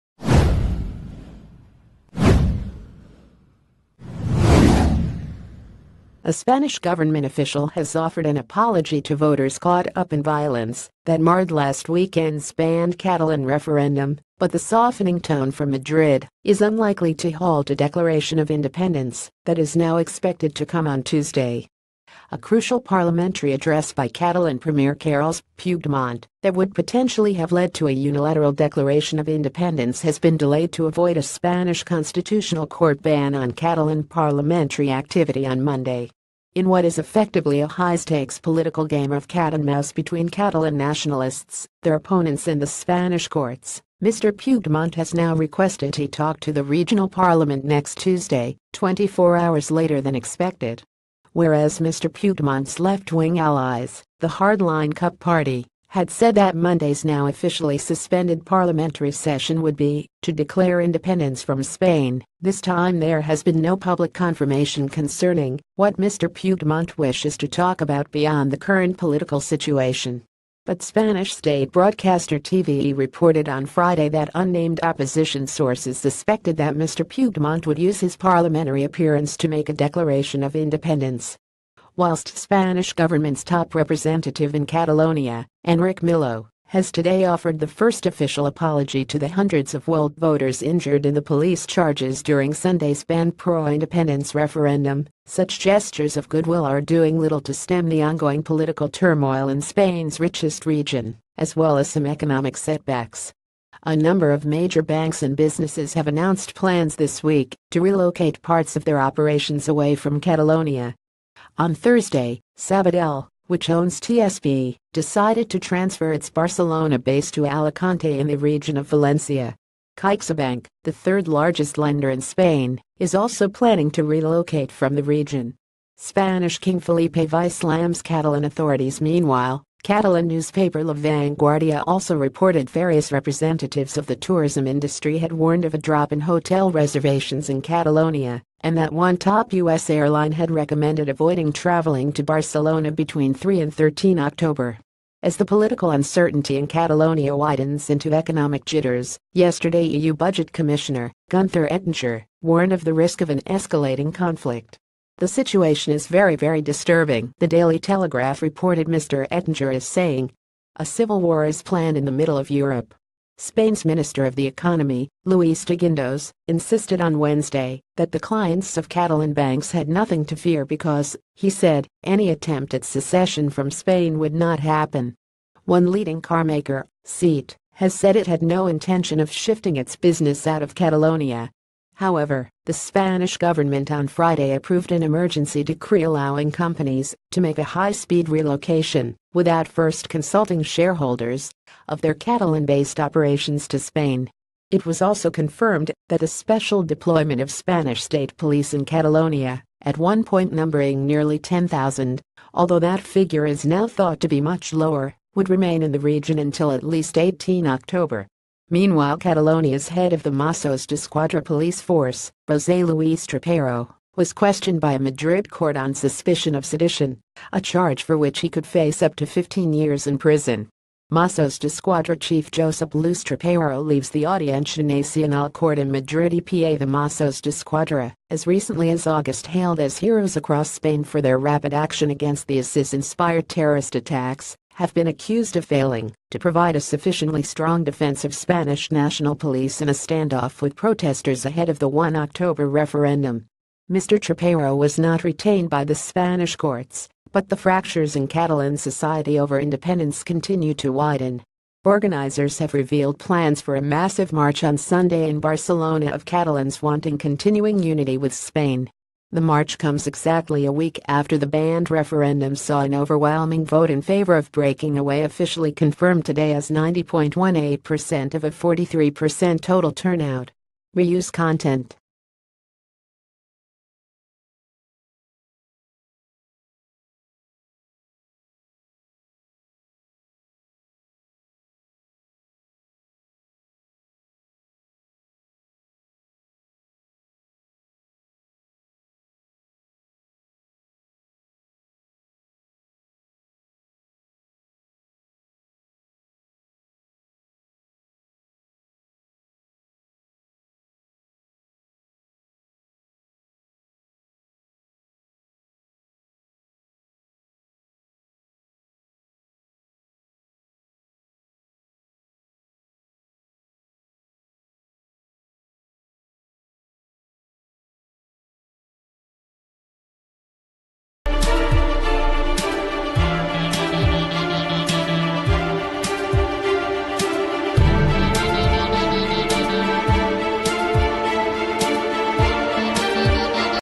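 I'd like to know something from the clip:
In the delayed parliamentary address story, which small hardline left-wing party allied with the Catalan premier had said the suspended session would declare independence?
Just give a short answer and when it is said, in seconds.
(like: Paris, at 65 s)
Cup Party, at 54 s.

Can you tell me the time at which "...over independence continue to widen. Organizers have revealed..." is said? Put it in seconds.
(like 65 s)
249 s.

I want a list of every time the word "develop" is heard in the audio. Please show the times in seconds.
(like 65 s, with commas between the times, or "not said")
not said.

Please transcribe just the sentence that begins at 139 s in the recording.
airline had recommended avoiding traveling to Barcelona between 3 and 13 October.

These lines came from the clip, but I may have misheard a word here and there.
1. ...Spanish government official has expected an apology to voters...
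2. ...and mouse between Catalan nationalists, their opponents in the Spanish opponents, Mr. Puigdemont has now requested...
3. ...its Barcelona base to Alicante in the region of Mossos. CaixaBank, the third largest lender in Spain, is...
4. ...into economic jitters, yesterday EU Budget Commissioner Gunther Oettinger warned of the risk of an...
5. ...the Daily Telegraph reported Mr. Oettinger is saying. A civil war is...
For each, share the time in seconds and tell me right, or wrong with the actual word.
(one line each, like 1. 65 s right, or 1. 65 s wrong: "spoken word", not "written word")
1. 6 s wrong: "offered", not "expected"
2. 39 s wrong: "courts", not "opponents"
3. 116 s wrong: "Valencia", not "Mossos"
4. 147 s right
5. 157 s right.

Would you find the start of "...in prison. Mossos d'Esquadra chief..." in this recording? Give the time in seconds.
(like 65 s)
220 s.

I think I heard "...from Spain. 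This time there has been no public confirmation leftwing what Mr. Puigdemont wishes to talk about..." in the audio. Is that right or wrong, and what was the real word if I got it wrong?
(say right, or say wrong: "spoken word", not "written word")
wrong: "concerning", not "leftwing".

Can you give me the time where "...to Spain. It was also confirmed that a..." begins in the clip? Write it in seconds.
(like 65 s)
193 s.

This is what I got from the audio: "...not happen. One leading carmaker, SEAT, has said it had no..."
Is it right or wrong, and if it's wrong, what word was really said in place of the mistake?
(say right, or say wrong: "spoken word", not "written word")
right.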